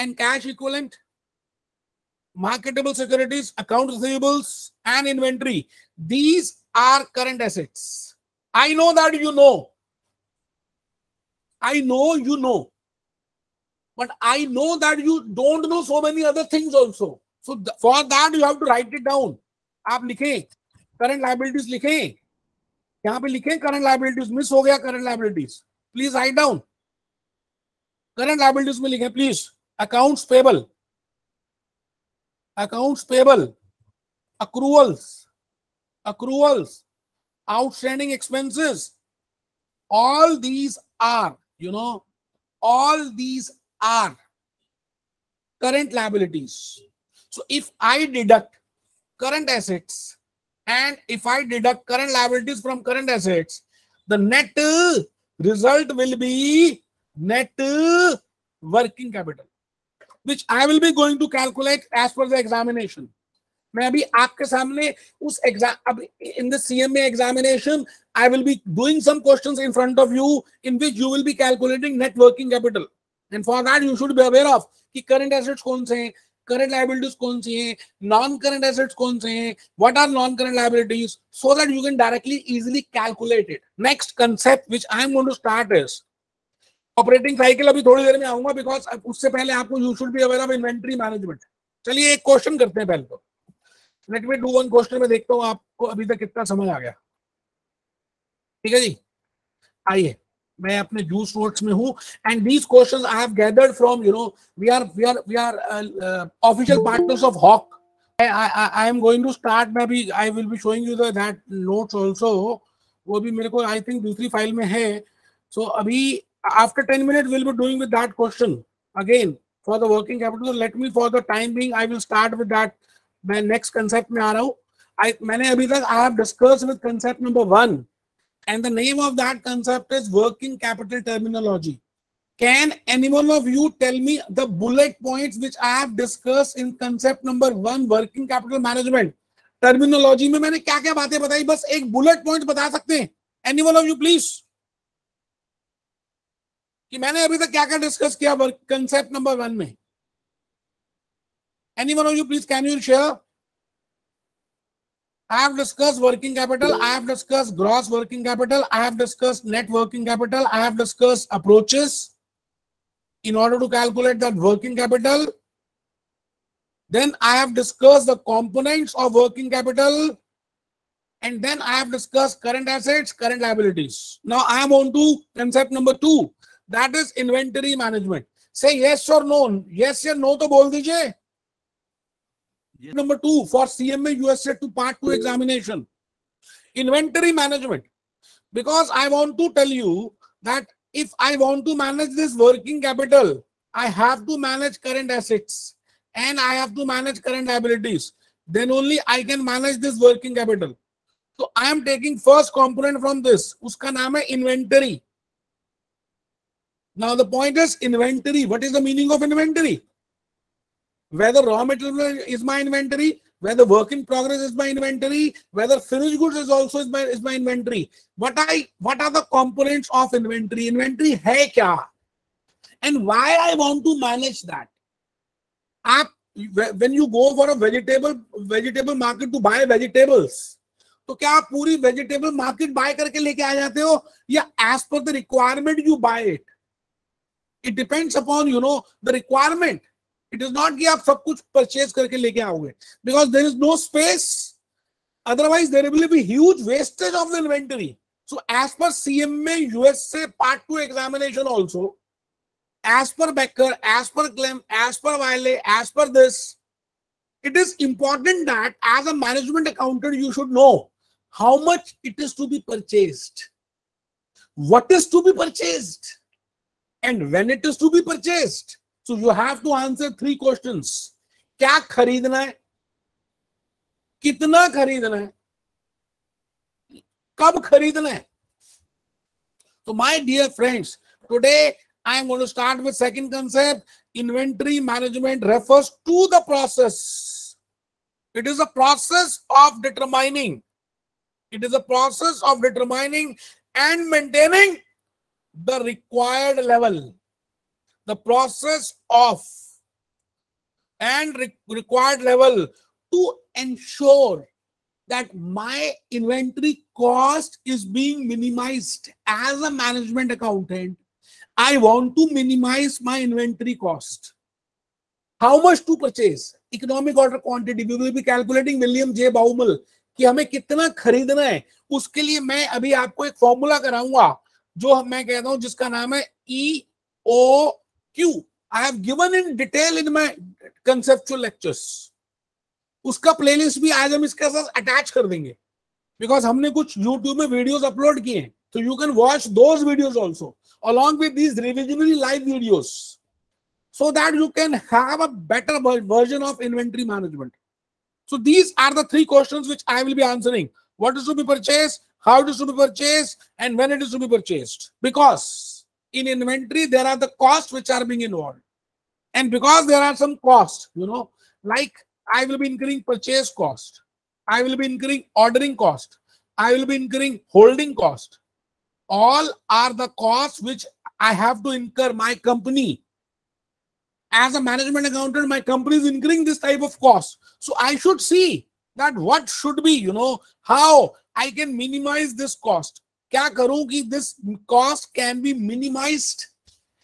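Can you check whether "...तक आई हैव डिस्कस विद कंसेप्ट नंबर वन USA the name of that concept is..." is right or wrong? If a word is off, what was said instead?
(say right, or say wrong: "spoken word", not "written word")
wrong: "And", not "USA".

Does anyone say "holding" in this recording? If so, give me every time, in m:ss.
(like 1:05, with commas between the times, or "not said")
6:07.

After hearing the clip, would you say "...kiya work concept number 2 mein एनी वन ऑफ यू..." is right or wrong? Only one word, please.
wrong.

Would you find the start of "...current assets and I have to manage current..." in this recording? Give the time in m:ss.
3:14.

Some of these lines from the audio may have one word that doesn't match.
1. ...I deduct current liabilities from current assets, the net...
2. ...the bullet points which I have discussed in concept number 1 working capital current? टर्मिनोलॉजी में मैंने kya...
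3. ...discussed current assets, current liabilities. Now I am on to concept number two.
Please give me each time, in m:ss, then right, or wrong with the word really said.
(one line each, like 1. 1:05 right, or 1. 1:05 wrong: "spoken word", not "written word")
1. 0:51 right
2. 2:14 wrong: "management", not "current"
3. 2:51 right.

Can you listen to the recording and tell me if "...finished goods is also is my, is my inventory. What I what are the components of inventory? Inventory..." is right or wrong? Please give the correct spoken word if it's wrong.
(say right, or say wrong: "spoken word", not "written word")
right.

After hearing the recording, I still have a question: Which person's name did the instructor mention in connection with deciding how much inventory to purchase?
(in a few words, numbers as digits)
William J Baumol.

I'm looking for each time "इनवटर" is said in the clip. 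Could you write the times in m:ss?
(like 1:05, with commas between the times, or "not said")
1:30, 4:07, 4:44.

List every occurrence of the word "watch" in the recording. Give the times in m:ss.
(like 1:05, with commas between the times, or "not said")
5:39.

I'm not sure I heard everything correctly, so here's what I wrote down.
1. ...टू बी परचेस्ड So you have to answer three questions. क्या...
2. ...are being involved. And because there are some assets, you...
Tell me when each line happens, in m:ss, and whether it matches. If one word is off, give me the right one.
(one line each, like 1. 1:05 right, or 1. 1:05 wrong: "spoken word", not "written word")
1. 4:27 right
2. 5:57 wrong: "costs", not "assets".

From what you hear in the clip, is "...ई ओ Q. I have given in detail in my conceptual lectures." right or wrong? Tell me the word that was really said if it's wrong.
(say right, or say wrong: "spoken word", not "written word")
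right.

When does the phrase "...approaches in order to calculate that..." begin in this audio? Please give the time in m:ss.
2:41.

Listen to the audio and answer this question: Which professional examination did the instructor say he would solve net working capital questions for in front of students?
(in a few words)
CMA examination.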